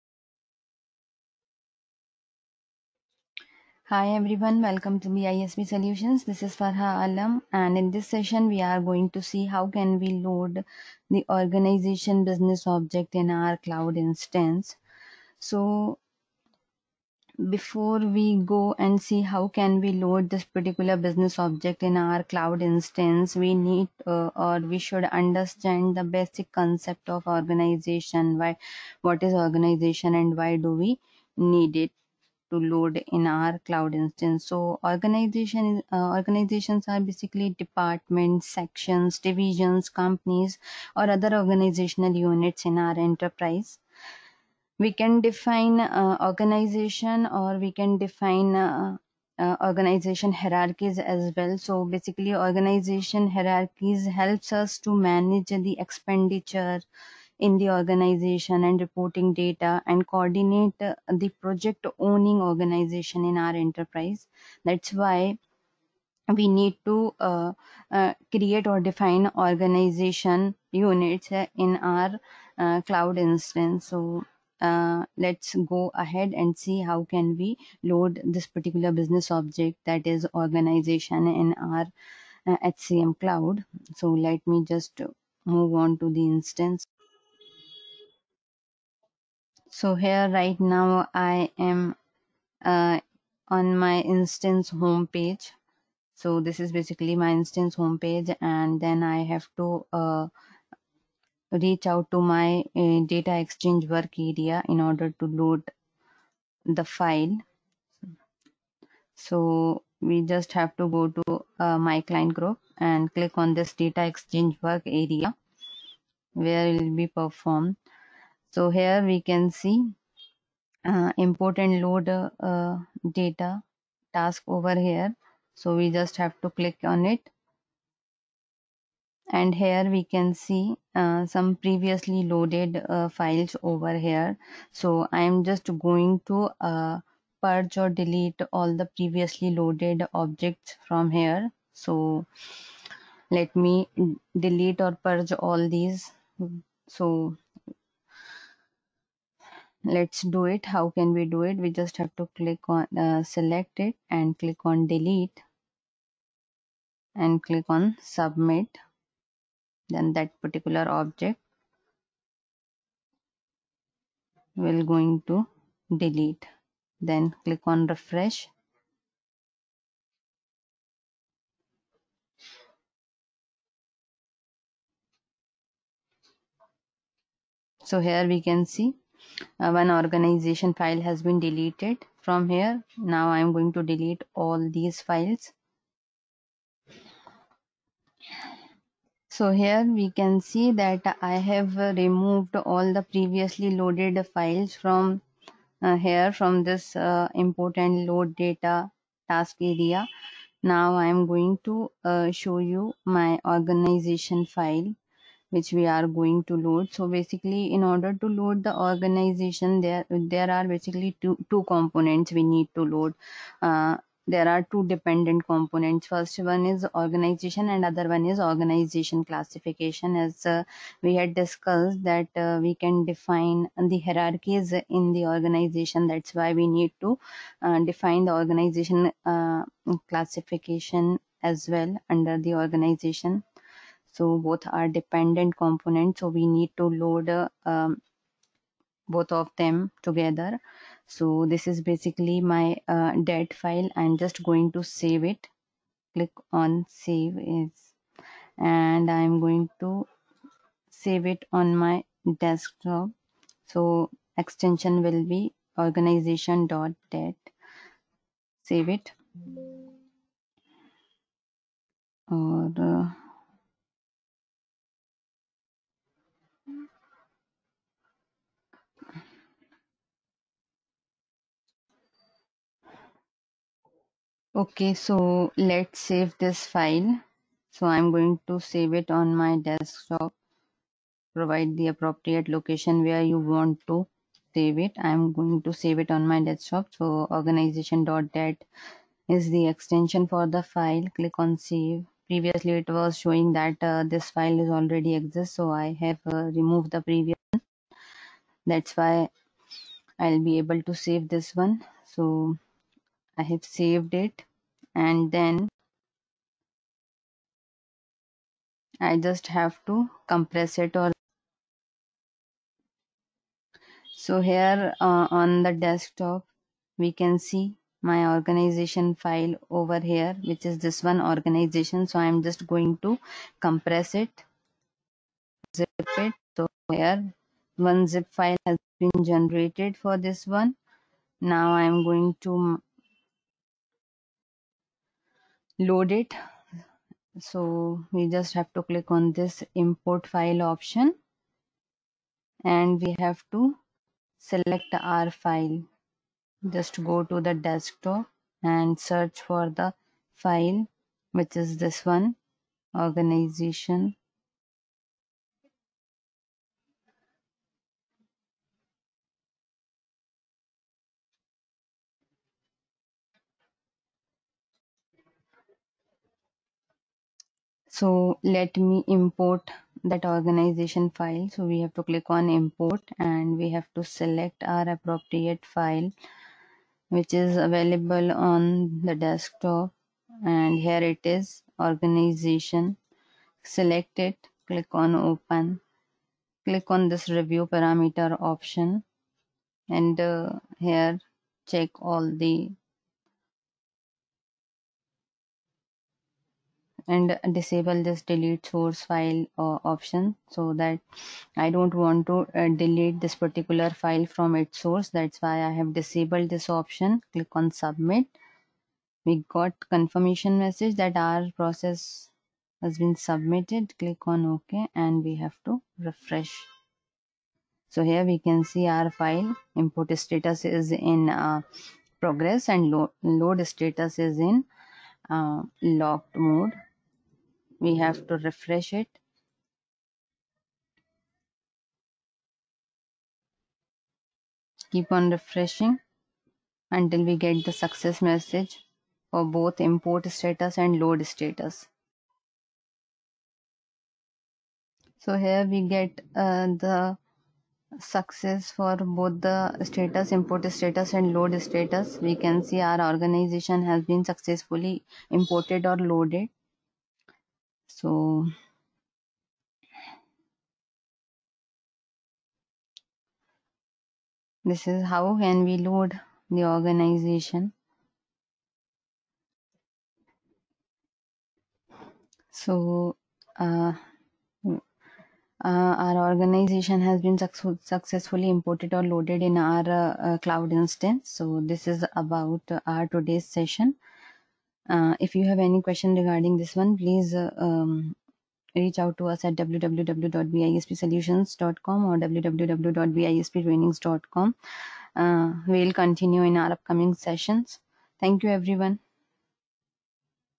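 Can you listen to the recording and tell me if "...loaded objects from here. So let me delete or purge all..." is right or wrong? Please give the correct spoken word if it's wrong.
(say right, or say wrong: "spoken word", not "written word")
right.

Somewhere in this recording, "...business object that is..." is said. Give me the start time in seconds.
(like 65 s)
78 s.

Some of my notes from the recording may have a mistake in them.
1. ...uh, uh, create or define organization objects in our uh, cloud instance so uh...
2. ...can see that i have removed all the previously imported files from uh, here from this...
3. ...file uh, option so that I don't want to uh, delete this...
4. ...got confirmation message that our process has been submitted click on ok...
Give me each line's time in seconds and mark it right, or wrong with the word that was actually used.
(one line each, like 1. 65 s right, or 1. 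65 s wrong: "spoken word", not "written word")
1. 67 s wrong: "units", not "objects"
2. 190 s wrong: "loaded", not "imported"
3. 399 s right
4. 409 s right.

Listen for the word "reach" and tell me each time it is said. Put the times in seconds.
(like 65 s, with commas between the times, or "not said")
101 s, 488 s.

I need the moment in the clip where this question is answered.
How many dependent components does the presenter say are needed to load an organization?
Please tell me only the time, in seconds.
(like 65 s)
214 s.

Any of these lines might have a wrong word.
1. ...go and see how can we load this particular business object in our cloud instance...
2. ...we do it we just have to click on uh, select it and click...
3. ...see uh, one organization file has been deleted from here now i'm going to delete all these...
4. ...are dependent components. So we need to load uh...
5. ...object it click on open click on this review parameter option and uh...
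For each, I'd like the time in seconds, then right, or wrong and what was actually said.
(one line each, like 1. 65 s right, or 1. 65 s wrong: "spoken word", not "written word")
1. 18 s right
2. 151 s right
3. 178 s right
4. 234 s right
5. 383 s wrong: "select", not "object".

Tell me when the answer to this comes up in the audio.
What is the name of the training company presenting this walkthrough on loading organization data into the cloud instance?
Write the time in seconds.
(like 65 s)
5 s.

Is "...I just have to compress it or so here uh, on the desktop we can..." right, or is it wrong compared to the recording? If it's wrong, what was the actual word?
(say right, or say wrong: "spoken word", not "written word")
right.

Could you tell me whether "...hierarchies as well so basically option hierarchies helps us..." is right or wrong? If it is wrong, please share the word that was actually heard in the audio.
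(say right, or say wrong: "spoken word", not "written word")
wrong: "organization", not "option".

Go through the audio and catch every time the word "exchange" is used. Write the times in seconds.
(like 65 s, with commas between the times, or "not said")
103 s, 114 s.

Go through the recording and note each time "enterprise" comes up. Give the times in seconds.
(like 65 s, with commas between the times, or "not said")
43 s, 63 s.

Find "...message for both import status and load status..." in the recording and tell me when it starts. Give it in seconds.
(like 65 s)
438 s.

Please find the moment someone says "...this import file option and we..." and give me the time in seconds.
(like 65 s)
339 s.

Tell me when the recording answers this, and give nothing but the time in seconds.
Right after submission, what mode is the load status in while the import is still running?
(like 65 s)
425 s.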